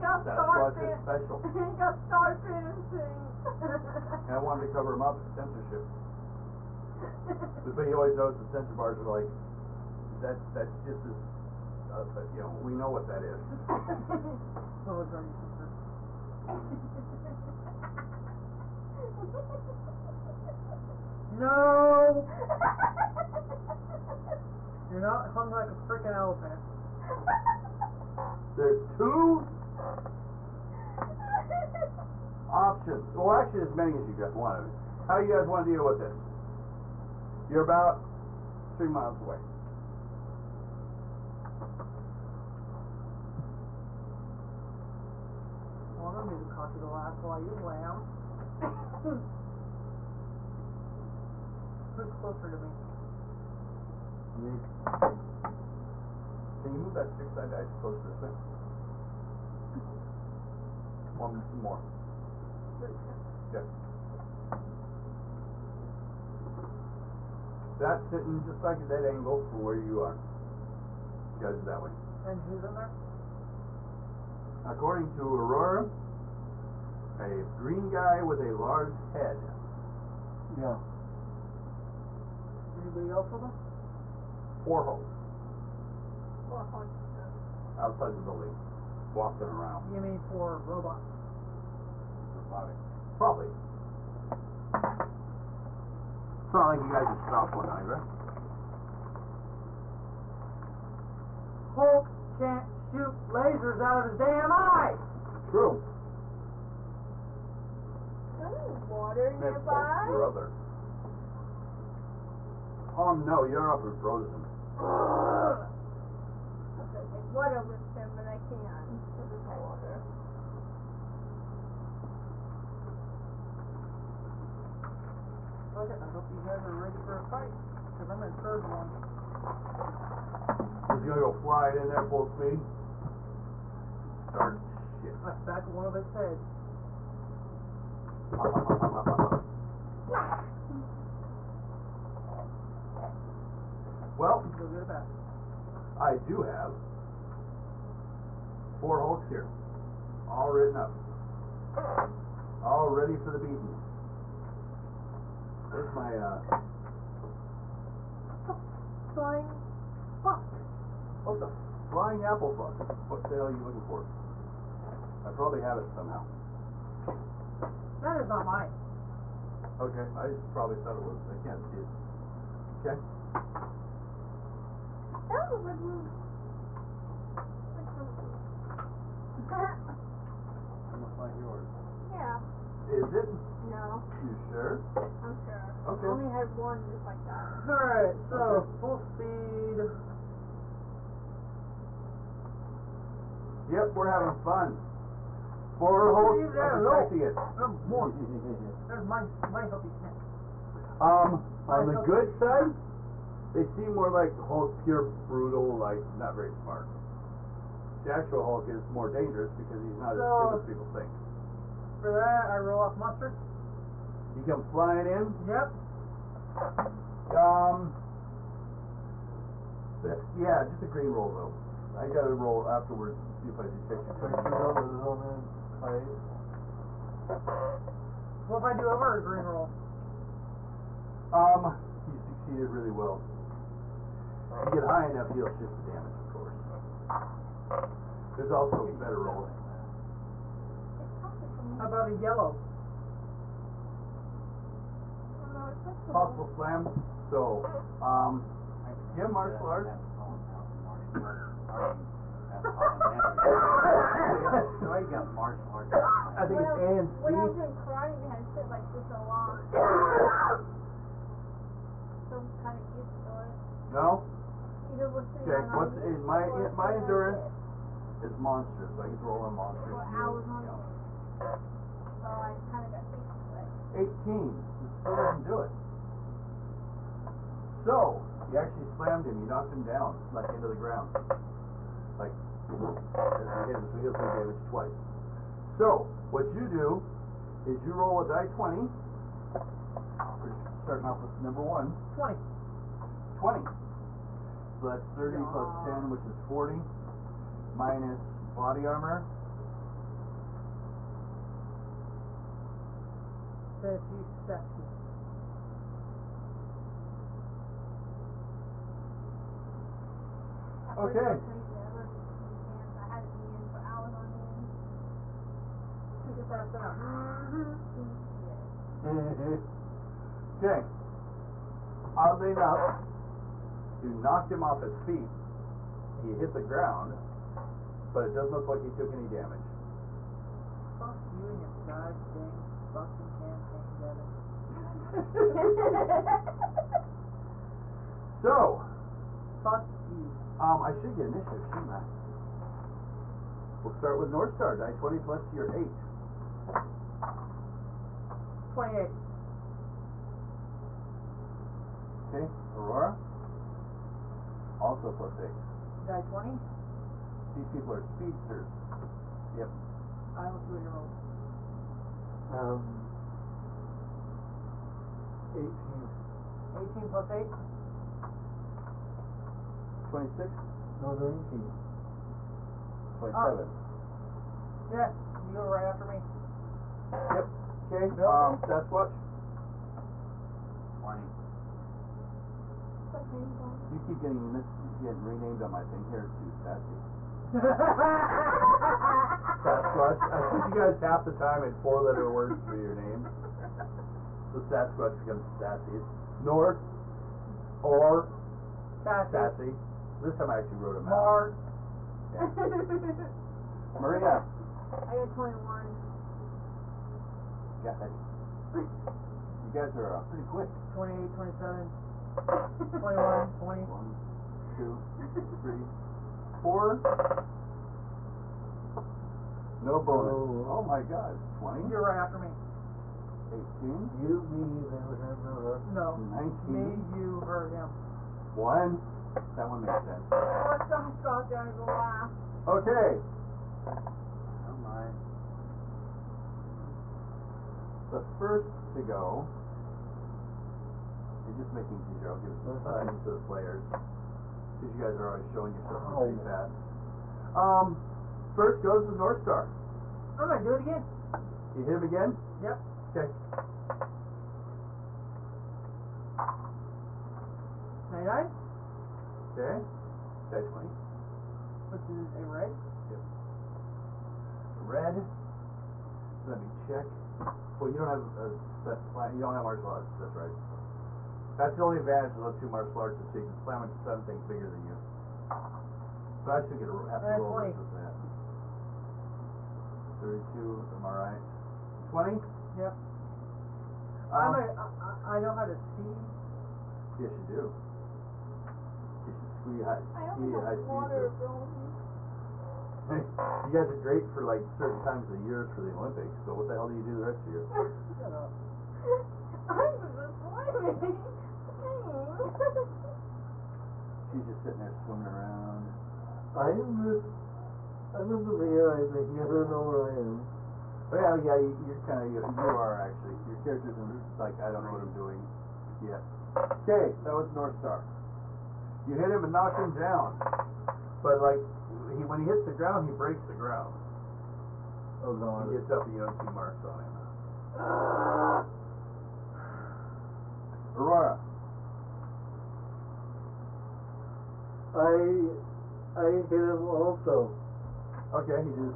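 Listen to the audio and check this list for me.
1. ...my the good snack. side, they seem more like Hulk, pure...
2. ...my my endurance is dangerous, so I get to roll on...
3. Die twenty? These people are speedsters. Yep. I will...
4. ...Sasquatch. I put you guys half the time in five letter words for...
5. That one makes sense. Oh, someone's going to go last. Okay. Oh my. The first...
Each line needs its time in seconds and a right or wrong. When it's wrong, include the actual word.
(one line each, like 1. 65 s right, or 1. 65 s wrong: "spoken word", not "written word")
1. 201 s right
2. 266 s wrong: "monstrous", not "dangerous"
3. 356 s right
4. 389 s wrong: "four", not "five"
5. 429 s right.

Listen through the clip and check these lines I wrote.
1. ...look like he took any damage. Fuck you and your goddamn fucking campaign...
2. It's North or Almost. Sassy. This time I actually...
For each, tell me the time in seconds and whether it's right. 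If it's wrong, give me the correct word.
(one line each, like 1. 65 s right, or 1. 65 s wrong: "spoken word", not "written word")
1. 328 s right
2. 395 s wrong: "Sassy", not "Almost".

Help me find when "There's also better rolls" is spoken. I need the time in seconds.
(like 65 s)
238 s.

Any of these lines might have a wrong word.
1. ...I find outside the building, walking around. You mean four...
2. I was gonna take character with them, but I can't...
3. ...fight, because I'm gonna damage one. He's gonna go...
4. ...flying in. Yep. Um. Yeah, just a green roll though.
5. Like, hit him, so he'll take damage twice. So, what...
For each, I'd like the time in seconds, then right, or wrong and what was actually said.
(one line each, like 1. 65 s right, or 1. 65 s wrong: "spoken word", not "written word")
1. 86 s right
2. 114 s wrong: "water", not "character"
3. 127 s wrong: "charge", not "damage"
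4. 214 s right
5. 282 s right.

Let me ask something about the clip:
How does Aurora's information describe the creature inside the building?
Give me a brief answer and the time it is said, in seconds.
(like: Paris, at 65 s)
a green guy with a large head, at 77 s.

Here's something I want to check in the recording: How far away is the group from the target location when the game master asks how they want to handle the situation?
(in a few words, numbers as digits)
3 miles.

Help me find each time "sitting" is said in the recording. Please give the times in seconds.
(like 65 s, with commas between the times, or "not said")
68 s, 504 s.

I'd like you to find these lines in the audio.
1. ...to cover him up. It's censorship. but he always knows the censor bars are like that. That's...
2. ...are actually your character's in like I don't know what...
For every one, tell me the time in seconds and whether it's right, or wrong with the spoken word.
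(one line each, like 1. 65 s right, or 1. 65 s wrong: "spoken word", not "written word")
1. 4 s right
2. 512 s right.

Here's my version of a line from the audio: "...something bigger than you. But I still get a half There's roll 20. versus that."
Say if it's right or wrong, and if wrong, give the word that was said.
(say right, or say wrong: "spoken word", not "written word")
right.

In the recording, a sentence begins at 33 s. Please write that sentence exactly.
Well, actually, as many as you guys want.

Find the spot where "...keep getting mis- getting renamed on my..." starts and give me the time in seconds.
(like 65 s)
384 s.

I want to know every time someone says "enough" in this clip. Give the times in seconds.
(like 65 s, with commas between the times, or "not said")
235 s, 322 s.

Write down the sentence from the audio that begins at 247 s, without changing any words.
So, um, do you have martial arts?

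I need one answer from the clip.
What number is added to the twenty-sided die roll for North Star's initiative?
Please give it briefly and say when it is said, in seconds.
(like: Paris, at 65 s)
8, at 345 s.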